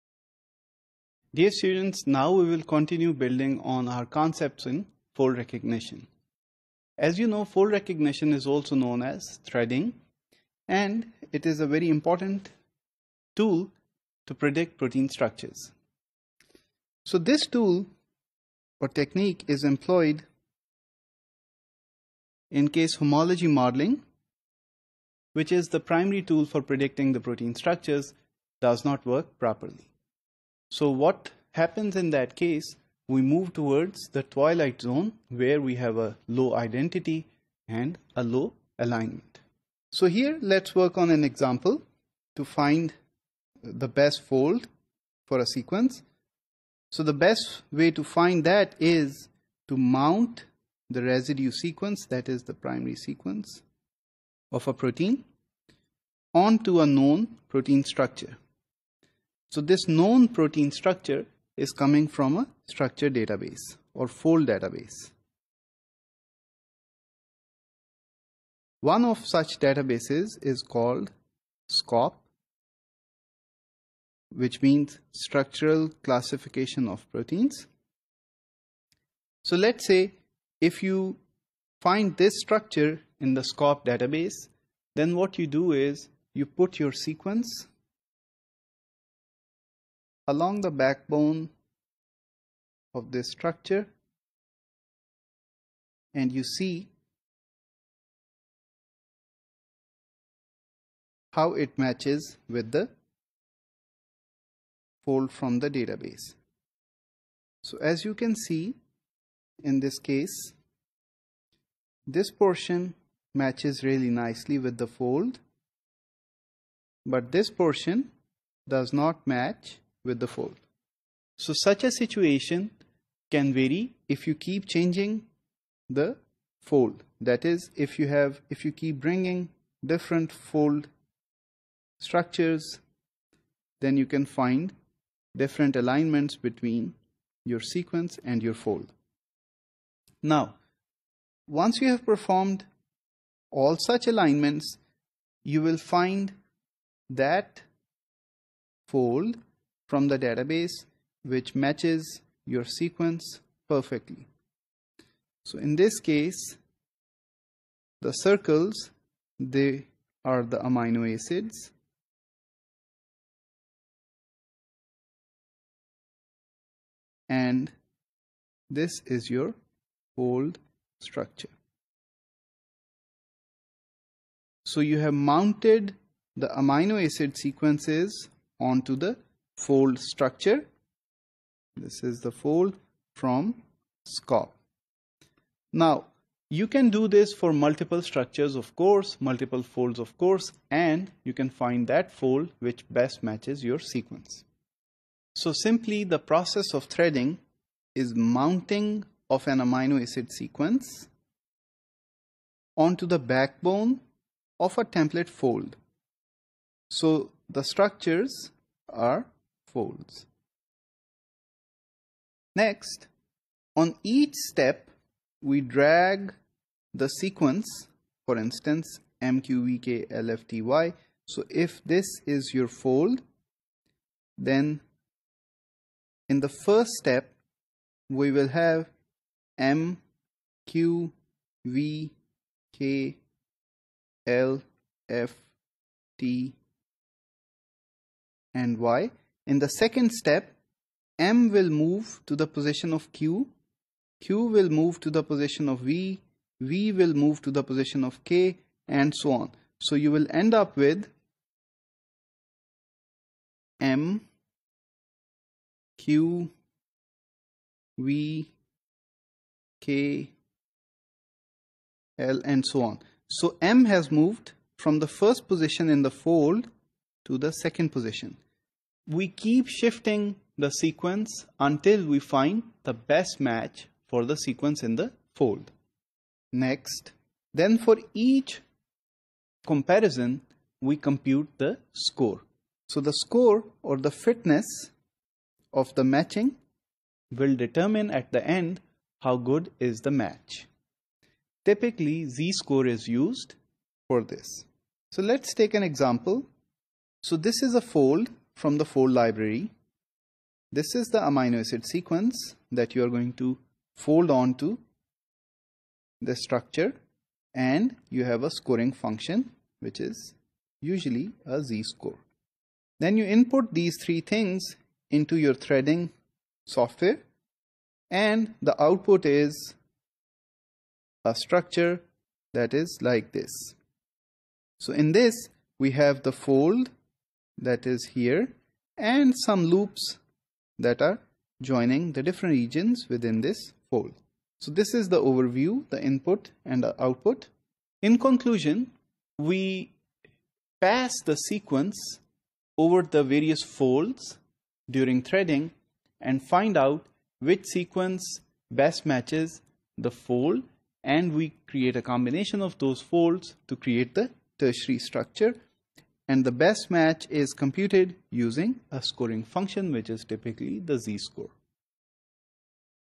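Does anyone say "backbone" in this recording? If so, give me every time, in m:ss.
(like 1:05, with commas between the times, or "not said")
1:30, 3:23.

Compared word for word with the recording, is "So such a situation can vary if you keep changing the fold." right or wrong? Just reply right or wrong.
right.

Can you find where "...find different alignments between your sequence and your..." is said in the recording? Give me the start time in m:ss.
2:14.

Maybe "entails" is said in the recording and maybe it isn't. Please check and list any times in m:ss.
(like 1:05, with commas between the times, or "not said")
not said.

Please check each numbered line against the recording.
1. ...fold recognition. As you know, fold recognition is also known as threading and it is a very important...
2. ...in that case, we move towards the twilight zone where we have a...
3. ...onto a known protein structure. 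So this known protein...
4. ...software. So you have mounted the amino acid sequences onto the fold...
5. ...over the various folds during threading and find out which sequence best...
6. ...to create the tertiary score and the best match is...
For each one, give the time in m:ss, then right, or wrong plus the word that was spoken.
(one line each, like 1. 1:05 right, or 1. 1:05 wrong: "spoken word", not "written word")
1. 0:05 right
2. 0:31 right
3. 0:56 right
4. 2:51 wrong: "structure", not "software"
5. 5:42 right
6. 5:53 wrong: "structure", not "score".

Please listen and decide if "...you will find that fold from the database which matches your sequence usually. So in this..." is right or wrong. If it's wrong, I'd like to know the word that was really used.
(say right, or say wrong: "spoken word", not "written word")
wrong: "perfectly", not "usually".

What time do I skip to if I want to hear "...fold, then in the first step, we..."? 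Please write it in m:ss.
3:42.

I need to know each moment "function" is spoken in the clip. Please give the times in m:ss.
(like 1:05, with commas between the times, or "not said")
5:08, 5:59.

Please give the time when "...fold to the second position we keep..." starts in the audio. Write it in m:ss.
4:26.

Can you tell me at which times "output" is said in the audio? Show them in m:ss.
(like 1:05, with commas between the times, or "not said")
5:18, 5:37.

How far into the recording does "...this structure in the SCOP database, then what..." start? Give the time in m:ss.
1:22.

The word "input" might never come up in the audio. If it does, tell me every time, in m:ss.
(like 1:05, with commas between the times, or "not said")
5:13, 5:36.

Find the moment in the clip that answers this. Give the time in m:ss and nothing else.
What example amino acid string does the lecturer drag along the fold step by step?
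3:39.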